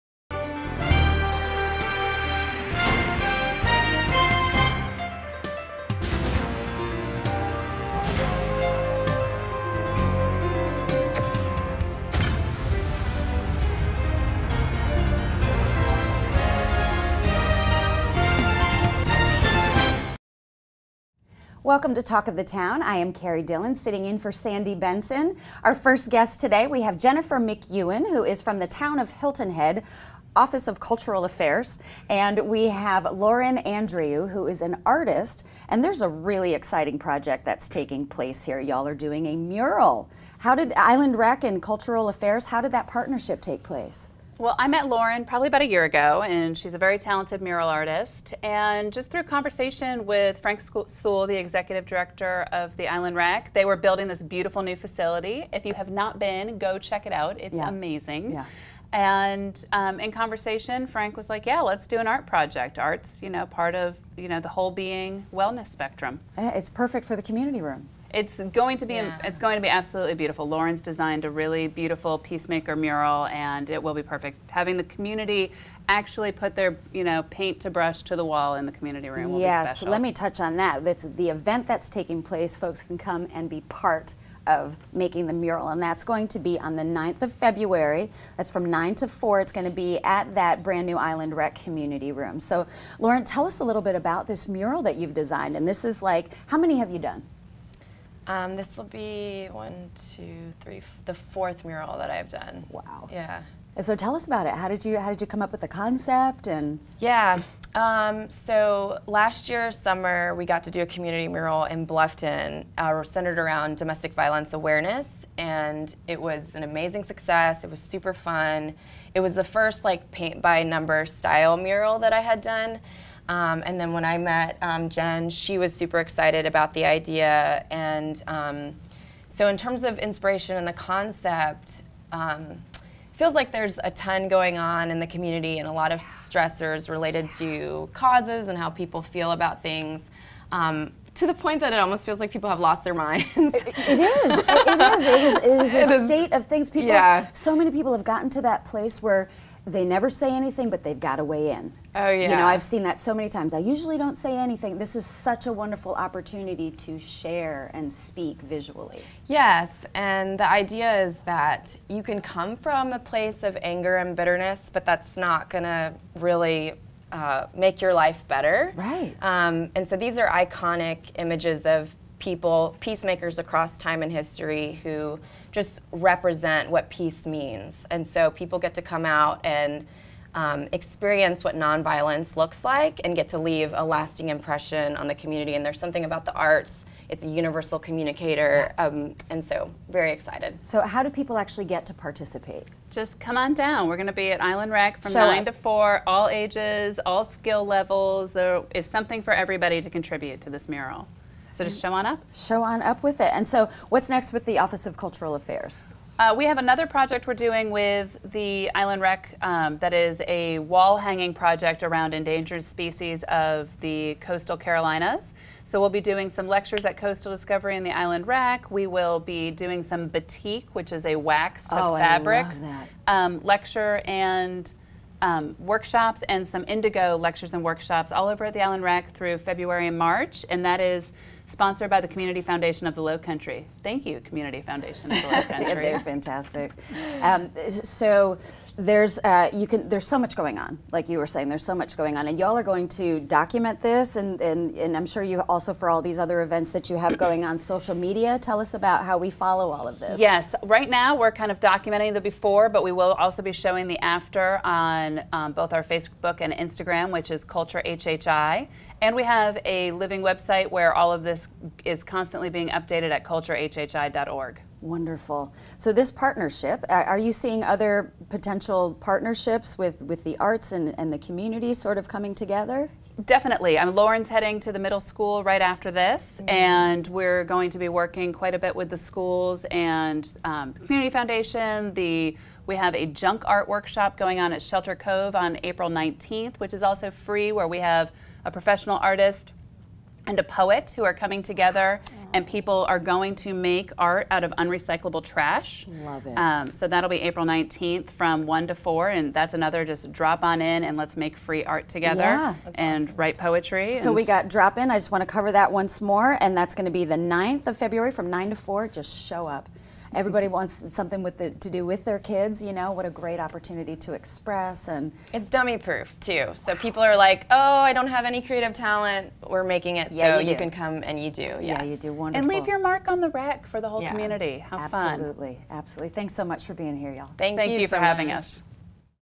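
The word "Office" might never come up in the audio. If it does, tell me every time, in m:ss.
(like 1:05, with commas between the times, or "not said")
0:30, 3:24.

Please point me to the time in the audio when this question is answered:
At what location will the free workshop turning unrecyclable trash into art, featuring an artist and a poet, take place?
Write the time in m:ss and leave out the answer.
4:44.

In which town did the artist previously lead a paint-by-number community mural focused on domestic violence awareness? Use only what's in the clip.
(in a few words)
Bluffton.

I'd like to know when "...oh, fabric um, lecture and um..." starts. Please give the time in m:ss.
3:41.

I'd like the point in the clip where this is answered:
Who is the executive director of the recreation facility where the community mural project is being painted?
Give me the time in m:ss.
0:50.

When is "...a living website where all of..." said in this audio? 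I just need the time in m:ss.
4:19.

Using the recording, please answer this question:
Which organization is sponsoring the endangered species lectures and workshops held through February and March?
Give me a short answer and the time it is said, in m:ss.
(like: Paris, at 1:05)
Community Foundation of the Low Country, at 3:52.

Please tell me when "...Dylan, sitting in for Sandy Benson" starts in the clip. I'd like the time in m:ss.
0:23.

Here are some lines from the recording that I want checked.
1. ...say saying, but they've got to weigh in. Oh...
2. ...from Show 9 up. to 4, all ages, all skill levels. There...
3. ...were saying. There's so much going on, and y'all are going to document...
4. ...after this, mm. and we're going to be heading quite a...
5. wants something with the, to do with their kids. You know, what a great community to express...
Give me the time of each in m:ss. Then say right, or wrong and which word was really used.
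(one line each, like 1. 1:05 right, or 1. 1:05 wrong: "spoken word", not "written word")
1. 2:30 wrong: "anything", not "saying"
2. 3:15 right
3. 4:01 right
4. 4:35 wrong: "working", not "heading"
5. 5:10 wrong: "opportunity", not "community".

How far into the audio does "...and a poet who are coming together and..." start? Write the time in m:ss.
4:50.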